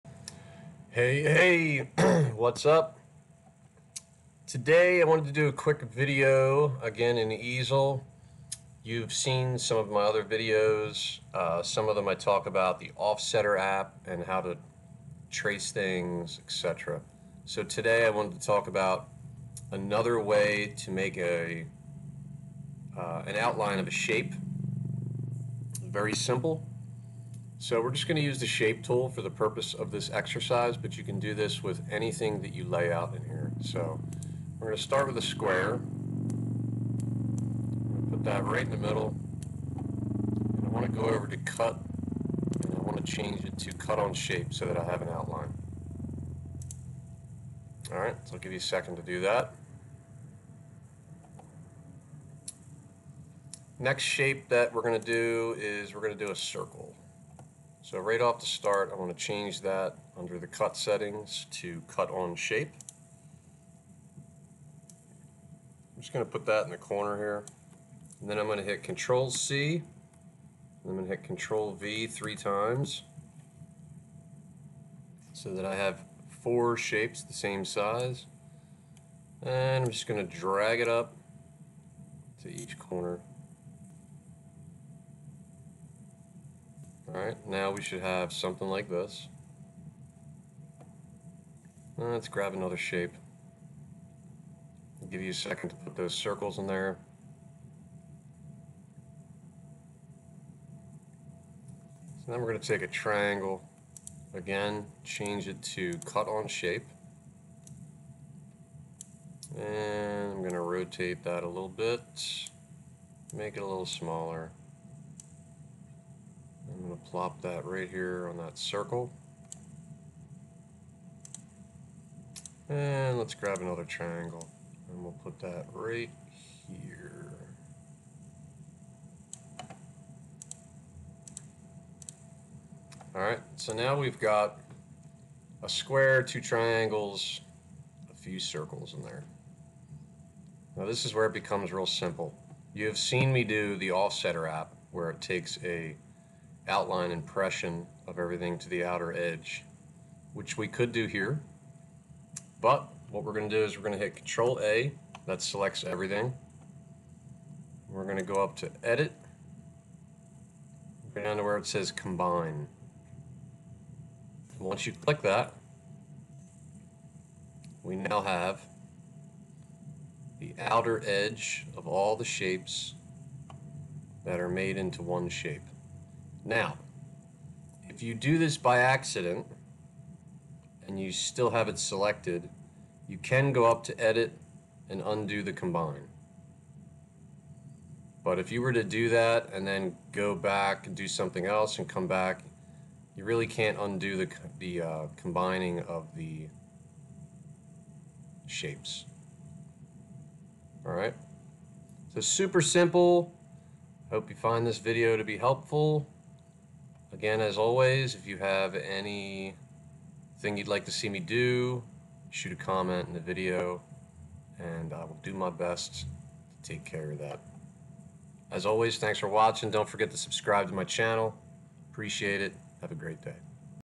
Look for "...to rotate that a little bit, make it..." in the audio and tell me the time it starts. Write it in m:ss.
1:50.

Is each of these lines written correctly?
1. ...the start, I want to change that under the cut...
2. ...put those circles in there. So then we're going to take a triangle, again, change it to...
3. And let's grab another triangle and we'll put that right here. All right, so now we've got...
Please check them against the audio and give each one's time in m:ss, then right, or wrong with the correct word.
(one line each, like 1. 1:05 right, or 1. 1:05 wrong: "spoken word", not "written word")
1. 0:58 right
2. 1:35 right
3. 2:02 right.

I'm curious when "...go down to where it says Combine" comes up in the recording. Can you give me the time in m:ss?
2:41.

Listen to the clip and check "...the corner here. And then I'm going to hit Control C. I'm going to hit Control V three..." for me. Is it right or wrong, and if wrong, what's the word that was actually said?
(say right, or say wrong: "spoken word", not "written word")
right.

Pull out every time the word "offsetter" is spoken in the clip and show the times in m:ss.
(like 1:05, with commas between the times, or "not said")
0:12, 2:23.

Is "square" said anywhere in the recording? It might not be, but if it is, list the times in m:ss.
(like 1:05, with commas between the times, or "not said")
0:35, 2:15.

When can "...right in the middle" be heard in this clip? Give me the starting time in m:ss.
0:38.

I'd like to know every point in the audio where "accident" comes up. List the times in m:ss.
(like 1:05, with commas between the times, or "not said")
2:58.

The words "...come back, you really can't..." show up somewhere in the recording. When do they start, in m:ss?
3:11.